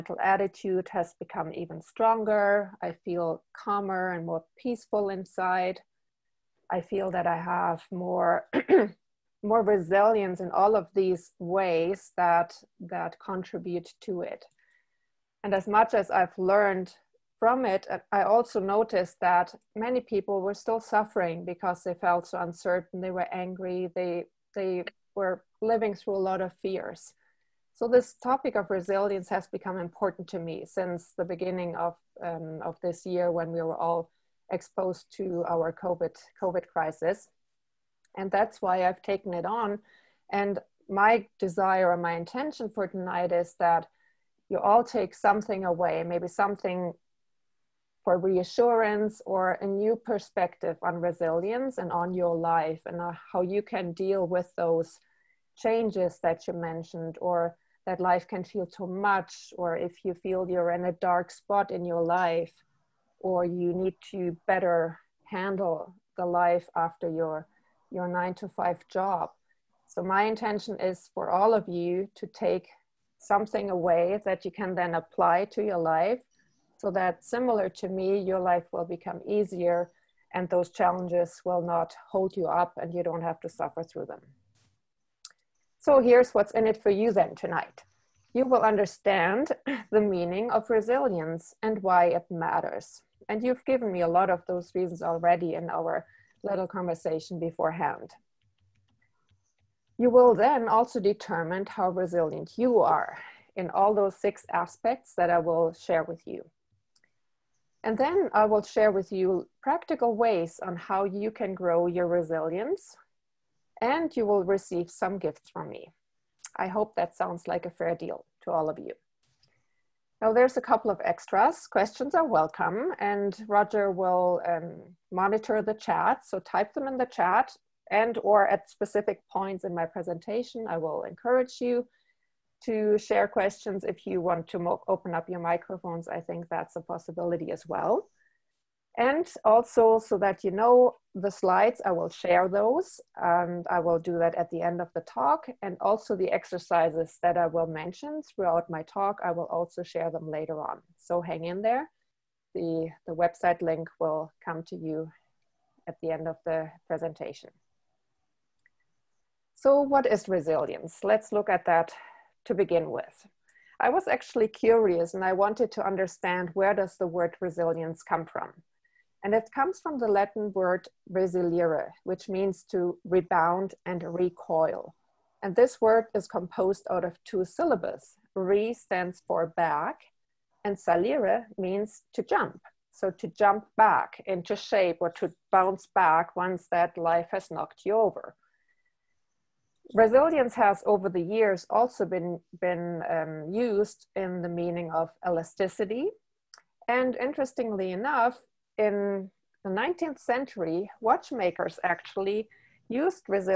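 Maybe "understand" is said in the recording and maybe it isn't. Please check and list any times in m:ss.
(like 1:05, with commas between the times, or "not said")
1:28, 2:45.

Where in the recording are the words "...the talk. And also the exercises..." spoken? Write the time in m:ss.
2:24.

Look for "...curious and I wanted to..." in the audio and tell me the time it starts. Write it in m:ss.
2:44.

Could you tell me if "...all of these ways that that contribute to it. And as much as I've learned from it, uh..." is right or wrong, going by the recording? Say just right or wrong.
right.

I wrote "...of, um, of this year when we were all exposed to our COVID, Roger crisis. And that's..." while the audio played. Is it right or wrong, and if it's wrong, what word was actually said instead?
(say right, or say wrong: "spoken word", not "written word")
wrong: "COVID", not "Roger".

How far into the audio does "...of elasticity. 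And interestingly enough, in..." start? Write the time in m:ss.
3:14.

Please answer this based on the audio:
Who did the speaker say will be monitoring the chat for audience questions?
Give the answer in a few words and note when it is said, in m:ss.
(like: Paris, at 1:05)
Roger, at 2:03.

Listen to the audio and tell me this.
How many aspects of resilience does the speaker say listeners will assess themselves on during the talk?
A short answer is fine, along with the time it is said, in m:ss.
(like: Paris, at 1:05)
6, at 1:44.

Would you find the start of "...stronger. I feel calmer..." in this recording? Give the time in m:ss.
0:01.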